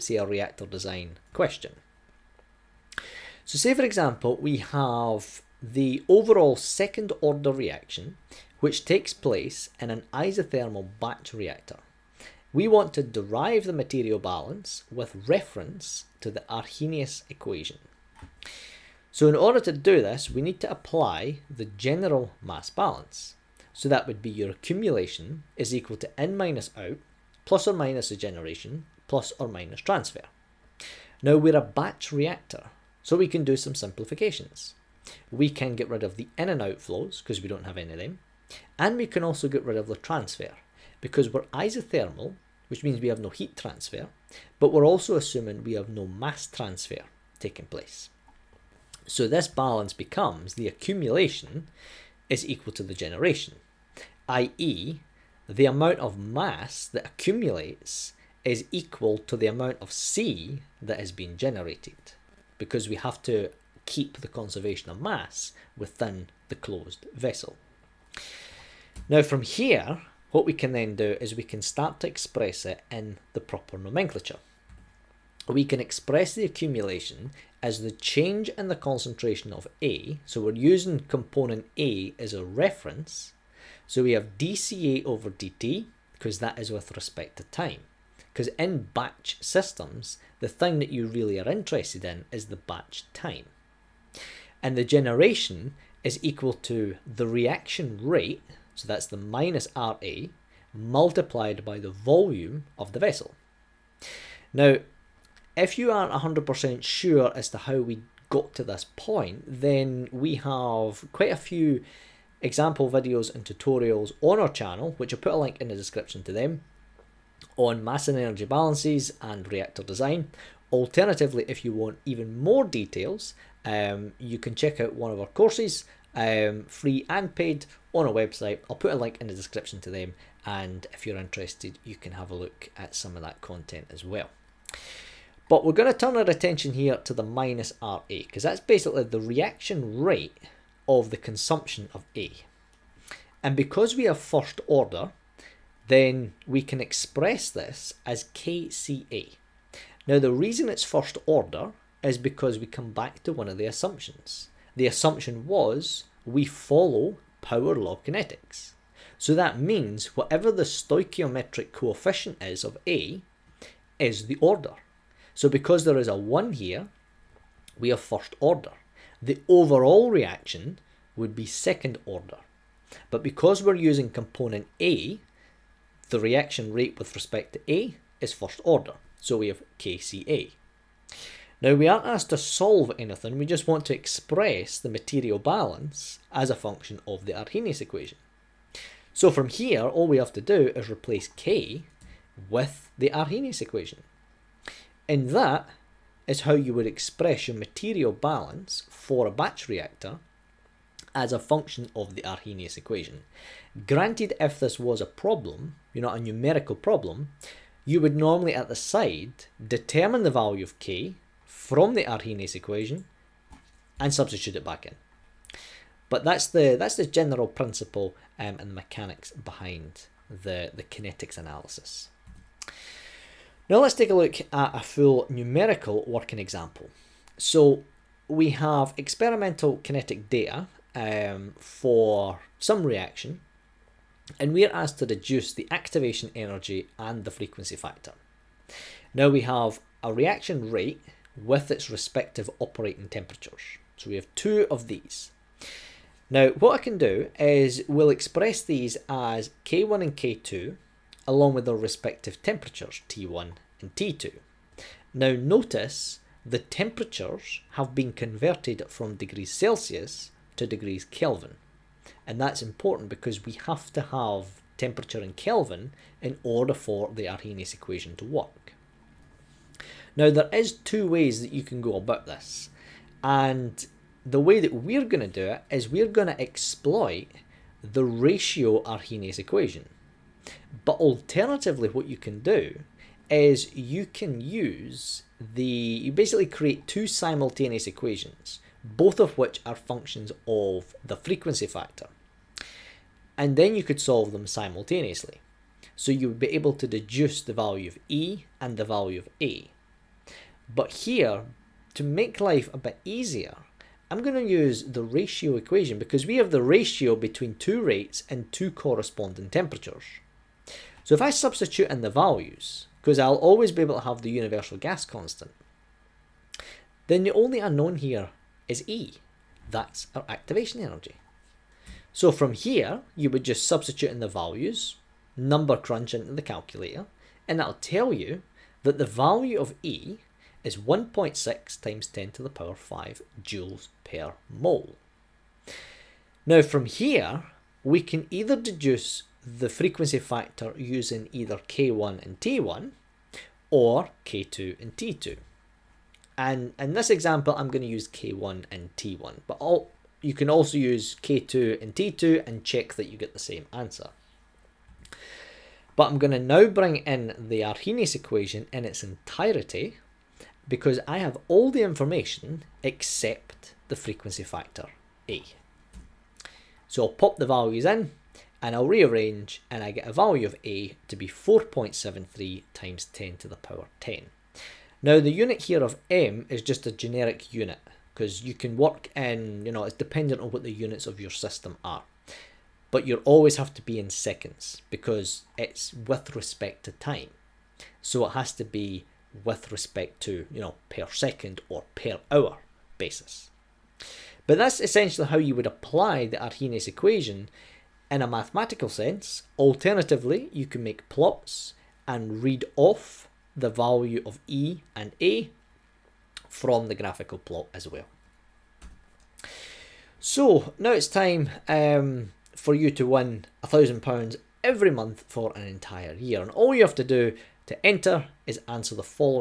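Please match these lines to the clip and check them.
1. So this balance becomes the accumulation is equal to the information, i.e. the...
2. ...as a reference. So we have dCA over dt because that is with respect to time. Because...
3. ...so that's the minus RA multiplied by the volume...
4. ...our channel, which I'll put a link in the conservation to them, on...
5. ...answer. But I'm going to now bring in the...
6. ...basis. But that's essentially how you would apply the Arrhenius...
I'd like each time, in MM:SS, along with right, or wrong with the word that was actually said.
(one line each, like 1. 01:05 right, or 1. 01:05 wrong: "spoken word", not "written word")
1. 00:49 wrong: "generation", not "information"
2. 01:22 right
3. 01:38 right
4. 01:54 wrong: "description", not "conservation"
5. 05:53 right
6. 06:32 right.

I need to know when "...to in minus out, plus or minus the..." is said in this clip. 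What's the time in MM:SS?
00:25.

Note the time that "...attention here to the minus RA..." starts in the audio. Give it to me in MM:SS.
02:16.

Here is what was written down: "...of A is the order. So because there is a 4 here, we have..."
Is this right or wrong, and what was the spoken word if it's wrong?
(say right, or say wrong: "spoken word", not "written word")
wrong: "1", not "4".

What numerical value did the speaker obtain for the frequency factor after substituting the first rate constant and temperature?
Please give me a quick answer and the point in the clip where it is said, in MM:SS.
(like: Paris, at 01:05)
4.73 x 10^10, at 06:11.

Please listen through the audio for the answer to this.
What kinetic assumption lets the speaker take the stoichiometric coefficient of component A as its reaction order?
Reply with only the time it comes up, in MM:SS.
02:37.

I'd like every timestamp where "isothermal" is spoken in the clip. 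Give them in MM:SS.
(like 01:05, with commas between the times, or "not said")
00:10, 00:41.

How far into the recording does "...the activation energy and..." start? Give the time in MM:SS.
03:55.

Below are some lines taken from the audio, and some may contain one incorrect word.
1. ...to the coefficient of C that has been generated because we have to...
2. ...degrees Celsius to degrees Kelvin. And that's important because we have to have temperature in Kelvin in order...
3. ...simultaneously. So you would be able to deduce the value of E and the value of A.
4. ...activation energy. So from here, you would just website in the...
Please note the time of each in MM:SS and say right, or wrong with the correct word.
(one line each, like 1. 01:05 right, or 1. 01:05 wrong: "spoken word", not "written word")
1. 00:59 wrong: "amount", not "coefficient"
2. 04:19 right
3. 04:54 right
4. 05:20 wrong: "substitute", not "website".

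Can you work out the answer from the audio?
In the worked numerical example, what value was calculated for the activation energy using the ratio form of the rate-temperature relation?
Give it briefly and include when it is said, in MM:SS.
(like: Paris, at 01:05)
1.6 x 10^5 J/mol, at 05:30.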